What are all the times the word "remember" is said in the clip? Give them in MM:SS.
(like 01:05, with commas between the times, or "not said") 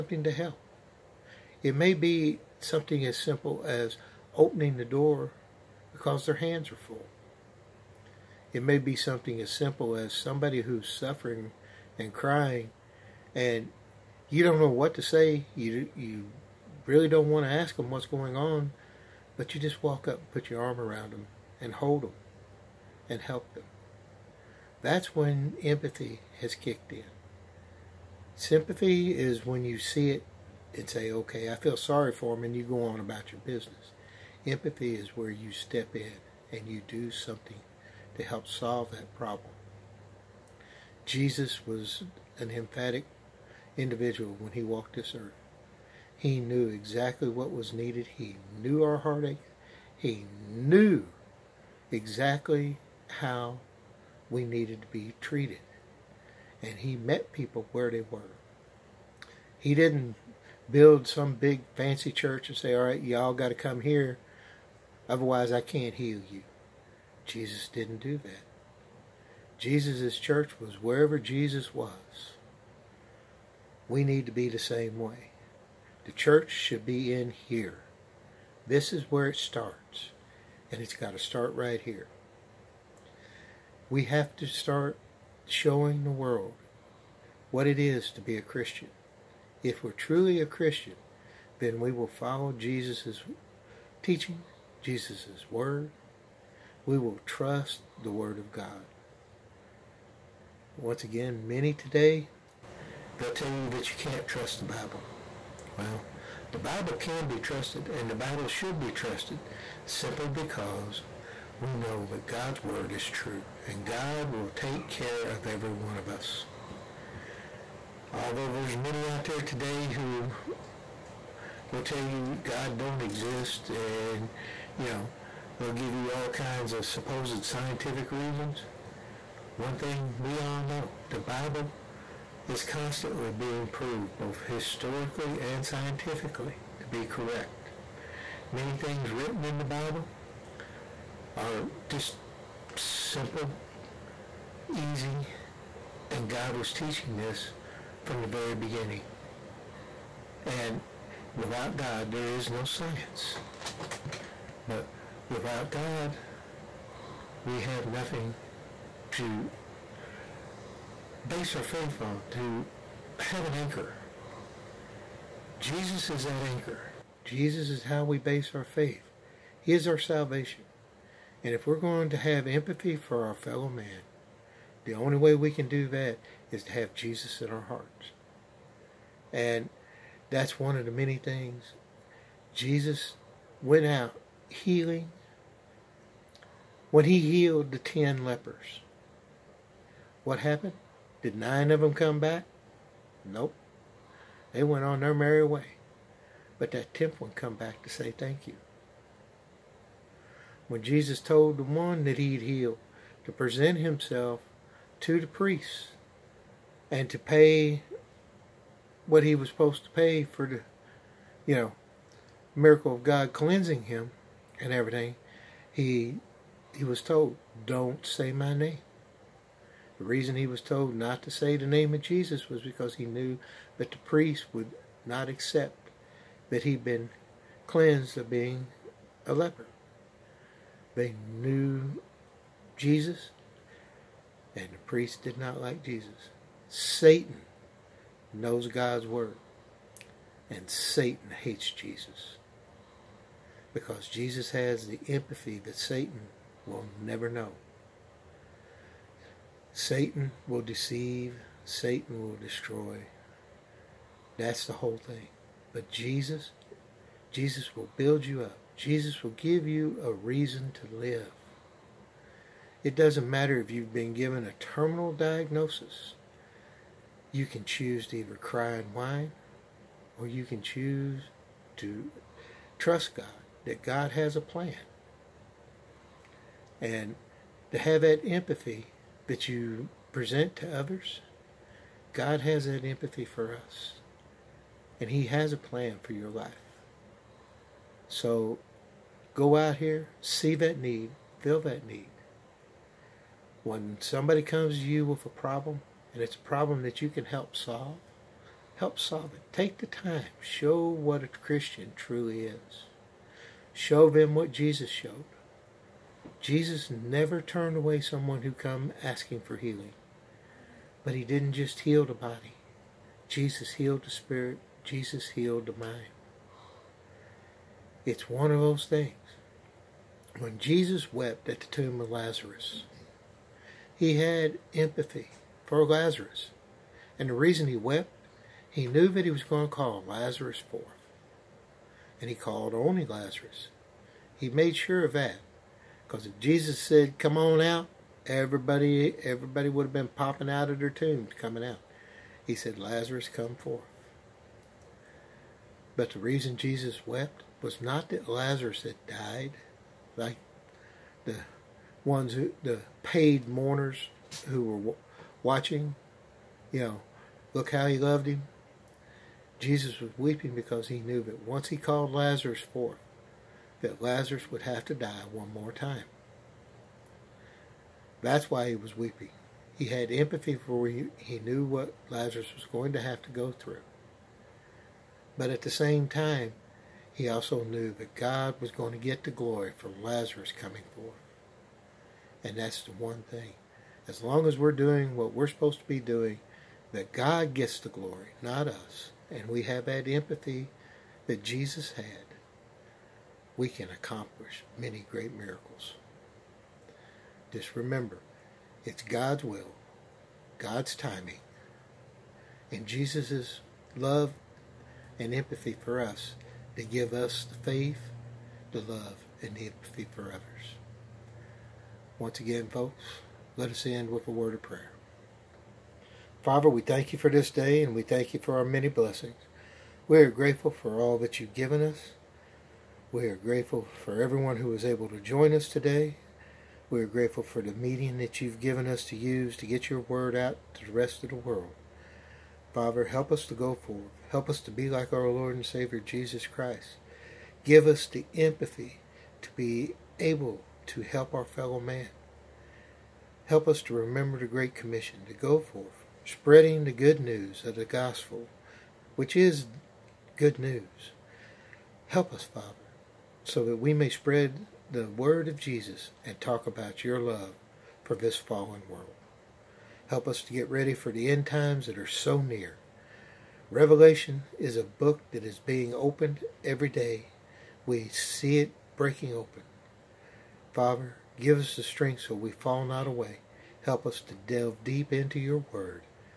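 06:37, 07:23.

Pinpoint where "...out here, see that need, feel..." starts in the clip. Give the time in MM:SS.
04:49.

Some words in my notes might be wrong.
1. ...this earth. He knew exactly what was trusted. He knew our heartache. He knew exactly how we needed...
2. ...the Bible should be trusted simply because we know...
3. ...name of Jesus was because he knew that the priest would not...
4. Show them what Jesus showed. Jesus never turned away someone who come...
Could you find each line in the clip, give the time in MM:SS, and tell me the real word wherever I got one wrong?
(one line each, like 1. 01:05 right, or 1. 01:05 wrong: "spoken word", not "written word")
1. 00:44 wrong: "needed", not "trusted"
2. 01:48 right
3. 03:41 right
4. 05:03 right.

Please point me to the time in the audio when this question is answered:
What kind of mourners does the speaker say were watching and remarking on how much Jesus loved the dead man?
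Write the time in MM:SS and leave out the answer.
05:53.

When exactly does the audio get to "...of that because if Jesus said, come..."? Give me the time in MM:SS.
05:35.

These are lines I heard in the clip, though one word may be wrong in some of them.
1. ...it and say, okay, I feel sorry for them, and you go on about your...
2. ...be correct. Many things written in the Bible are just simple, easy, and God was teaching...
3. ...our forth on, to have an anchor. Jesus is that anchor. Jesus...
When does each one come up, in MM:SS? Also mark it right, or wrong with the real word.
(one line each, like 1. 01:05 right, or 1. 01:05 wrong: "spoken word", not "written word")
1. 00:30 right
2. 02:16 right
3. 02:41 wrong: "faith", not "forth".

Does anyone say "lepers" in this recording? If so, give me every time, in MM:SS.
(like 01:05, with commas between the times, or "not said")
03:08, 03:49.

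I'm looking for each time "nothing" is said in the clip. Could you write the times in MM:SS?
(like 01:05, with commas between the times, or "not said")
02:37.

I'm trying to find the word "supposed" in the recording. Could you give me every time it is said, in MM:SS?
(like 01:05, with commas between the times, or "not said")
02:06, 03:29, 06:25.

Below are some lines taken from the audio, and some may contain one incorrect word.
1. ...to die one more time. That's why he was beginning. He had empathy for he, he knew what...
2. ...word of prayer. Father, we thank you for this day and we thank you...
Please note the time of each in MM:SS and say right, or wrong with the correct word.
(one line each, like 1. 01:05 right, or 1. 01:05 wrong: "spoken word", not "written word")
1. 06:04 wrong: "weeping", not "beginning"
2. 06:54 right.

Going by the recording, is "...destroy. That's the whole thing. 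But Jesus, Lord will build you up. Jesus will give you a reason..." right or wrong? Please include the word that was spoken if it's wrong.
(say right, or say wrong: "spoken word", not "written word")
wrong: "Jesus", not "Lord".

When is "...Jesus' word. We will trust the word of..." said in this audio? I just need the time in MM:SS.
01:34.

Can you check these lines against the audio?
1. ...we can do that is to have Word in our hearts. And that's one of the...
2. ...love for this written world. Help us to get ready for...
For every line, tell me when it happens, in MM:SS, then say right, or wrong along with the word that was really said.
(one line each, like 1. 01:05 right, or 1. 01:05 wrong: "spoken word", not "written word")
1. 02:55 wrong: "Jesus", not "Word"
2. 07:37 wrong: "fallen", not "written".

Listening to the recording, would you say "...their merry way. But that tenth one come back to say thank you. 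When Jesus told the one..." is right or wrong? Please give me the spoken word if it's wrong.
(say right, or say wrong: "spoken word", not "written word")
right.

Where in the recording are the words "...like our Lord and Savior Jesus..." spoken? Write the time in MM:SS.
07:14.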